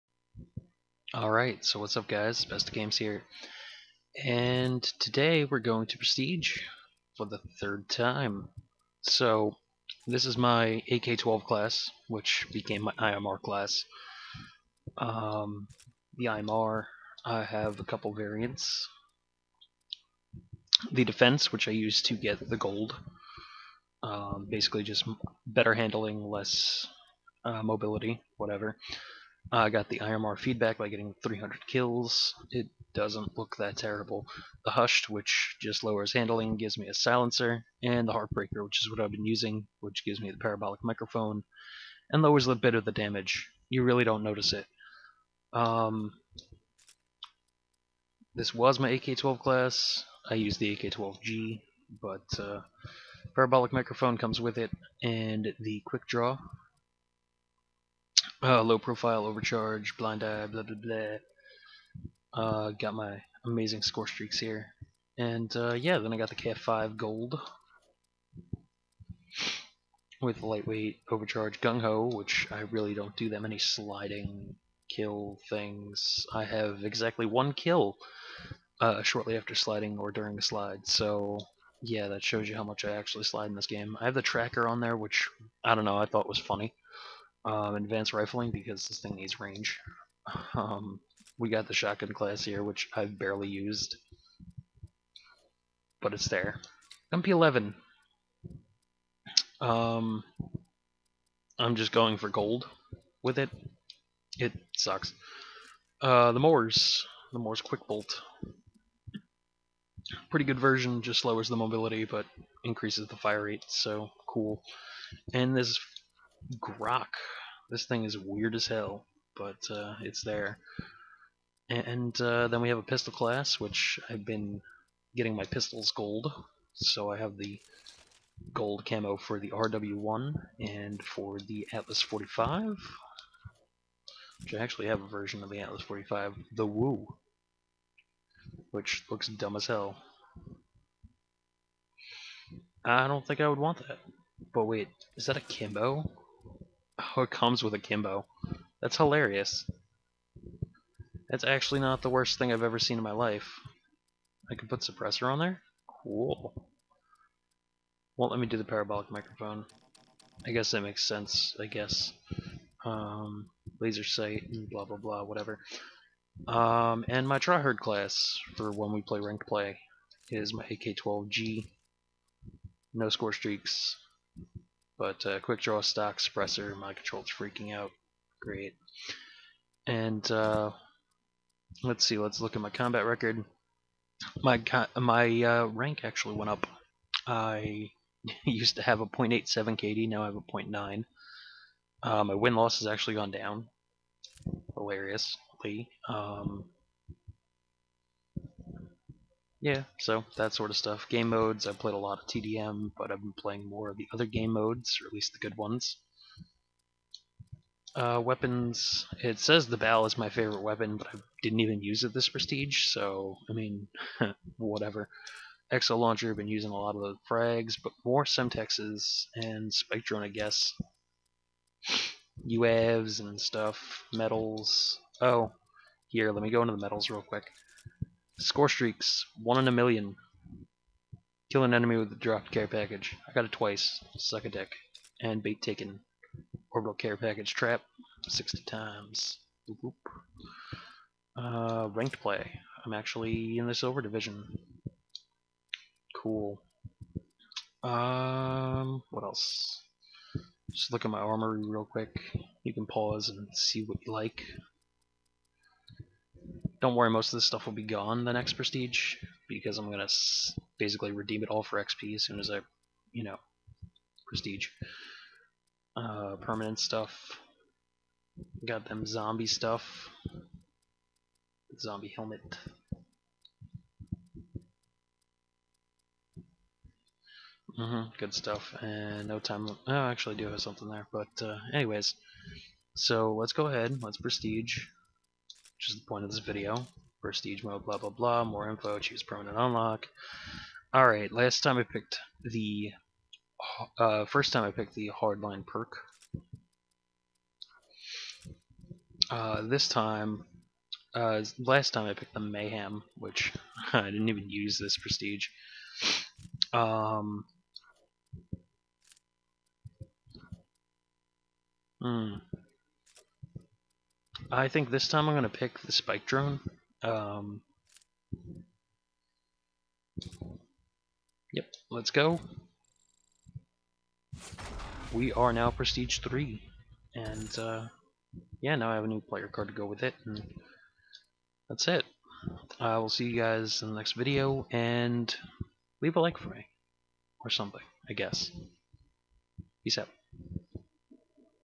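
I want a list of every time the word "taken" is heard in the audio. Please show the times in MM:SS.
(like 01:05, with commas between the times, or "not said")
03:55.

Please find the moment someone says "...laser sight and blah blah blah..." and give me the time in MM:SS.
02:43.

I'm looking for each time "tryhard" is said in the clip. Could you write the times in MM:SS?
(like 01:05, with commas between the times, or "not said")
02:47.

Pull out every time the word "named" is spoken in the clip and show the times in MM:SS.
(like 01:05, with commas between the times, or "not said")
not said.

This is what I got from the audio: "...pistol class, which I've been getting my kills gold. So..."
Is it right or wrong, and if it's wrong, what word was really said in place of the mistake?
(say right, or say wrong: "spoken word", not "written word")
wrong: "pistols", not "kills".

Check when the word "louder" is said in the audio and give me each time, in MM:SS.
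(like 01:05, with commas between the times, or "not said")
not said.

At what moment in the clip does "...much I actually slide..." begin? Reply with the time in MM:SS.
01:22.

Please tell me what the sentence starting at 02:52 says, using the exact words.
No score streaks, but uh, quick draw stock suppressor, my control's freaking out.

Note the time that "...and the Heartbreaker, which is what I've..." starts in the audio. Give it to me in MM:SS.
00:37.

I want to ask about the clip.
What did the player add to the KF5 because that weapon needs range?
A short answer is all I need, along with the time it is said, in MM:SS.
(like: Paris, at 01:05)
advanced rifling, at 01:27.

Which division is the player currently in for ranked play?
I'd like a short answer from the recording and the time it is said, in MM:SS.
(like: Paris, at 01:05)
silver, at 04:03.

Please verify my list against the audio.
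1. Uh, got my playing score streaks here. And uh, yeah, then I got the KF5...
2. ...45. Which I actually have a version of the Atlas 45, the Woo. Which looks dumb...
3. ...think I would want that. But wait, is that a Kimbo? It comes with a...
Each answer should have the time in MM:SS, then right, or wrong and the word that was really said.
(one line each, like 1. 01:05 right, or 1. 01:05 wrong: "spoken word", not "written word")
1. 01:02 wrong: "amazing", not "playing"
2. 02:12 right
3. 02:23 right.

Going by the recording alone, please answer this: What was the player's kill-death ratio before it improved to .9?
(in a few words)
.87.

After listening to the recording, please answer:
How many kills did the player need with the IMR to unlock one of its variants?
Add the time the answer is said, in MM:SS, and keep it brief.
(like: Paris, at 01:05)
300, at 00:31.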